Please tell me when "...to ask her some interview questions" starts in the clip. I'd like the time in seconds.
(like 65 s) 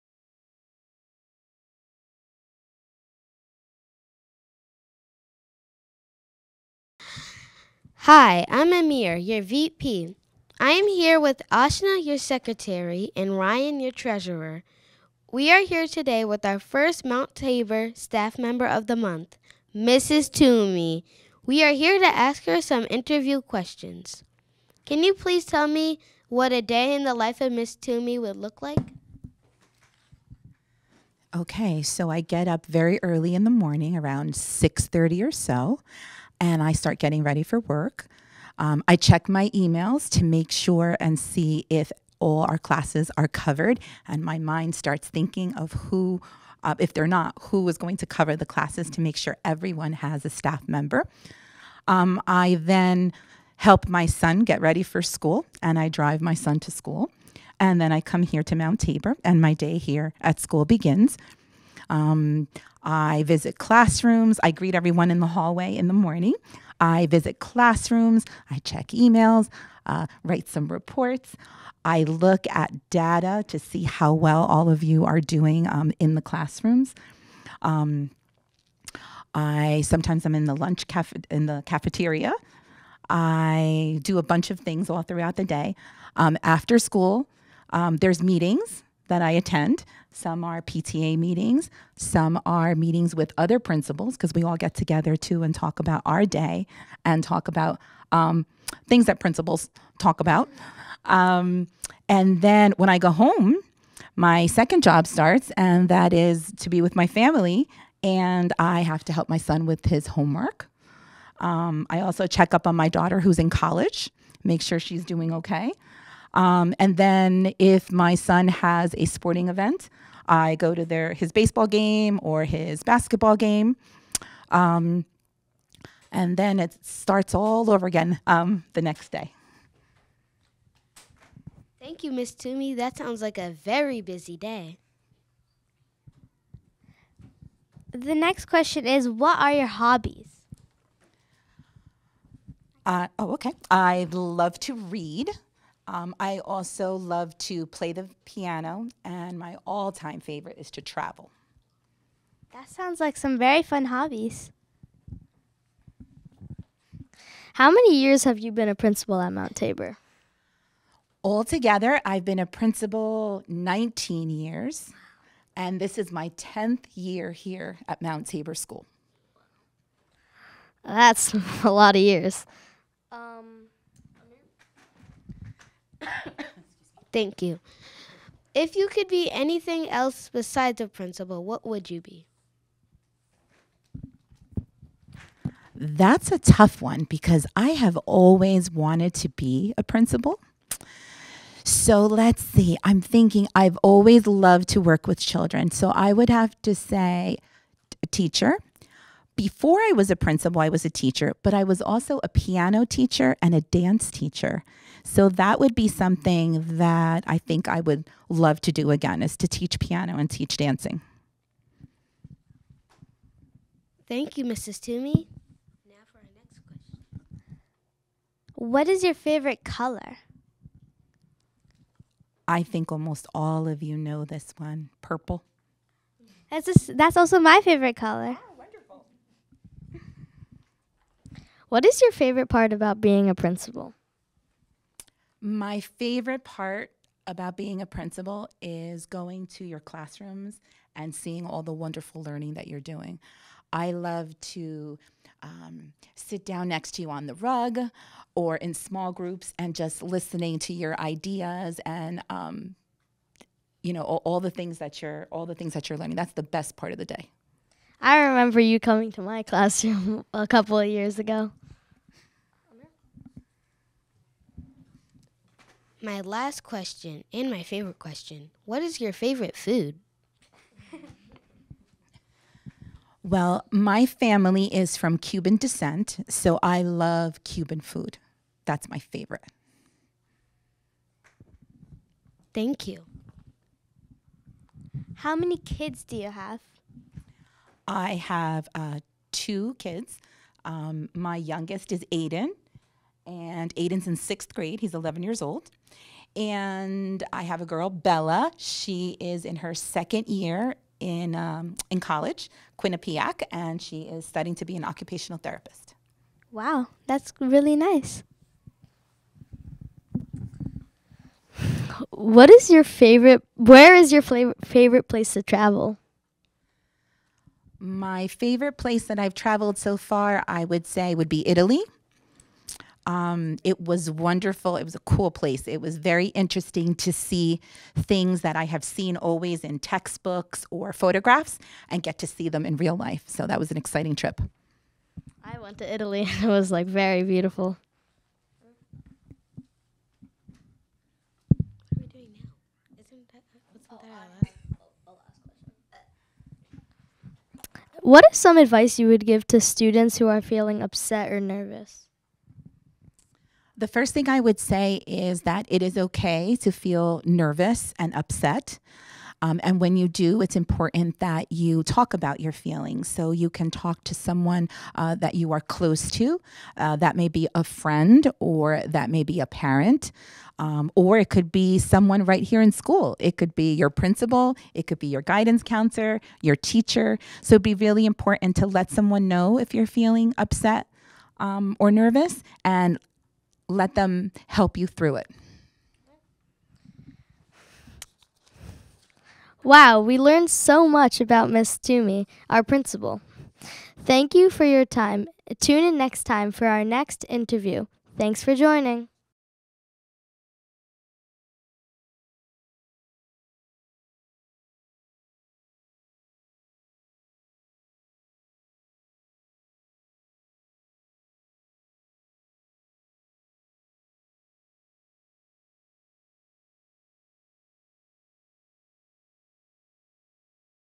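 21 s.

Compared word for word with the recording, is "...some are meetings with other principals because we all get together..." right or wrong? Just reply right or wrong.
right.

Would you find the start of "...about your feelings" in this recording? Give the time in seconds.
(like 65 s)
362 s.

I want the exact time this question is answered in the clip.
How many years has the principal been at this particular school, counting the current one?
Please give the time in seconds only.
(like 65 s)
166 s.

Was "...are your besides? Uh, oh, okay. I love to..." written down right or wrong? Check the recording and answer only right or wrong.
wrong.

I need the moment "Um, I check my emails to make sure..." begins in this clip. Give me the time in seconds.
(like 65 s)
38 s.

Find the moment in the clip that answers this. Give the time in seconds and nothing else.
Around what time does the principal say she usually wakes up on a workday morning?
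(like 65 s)
34 s.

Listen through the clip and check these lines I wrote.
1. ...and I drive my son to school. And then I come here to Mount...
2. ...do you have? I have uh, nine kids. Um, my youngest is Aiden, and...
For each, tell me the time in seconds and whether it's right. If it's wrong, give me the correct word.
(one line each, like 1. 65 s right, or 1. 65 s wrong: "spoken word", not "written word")
1. 55 s right
2. 286 s wrong: "two", not "nine".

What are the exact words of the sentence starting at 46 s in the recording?
Uh, if they're not, who is going to cover the classes to make sure everyone has a staff member?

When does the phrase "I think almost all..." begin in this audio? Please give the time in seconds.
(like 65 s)
222 s.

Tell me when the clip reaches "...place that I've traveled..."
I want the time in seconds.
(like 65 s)
318 s.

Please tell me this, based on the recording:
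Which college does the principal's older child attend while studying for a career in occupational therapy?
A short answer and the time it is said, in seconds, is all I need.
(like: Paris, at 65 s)
Quinnipiac, at 302 s.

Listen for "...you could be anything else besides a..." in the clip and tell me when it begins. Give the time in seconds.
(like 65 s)
178 s.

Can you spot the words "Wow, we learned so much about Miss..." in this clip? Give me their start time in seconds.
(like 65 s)
389 s.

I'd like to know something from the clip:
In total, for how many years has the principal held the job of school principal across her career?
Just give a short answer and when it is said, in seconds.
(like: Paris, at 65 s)
19, at 163 s.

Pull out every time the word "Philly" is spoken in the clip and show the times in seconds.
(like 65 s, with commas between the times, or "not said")
not said.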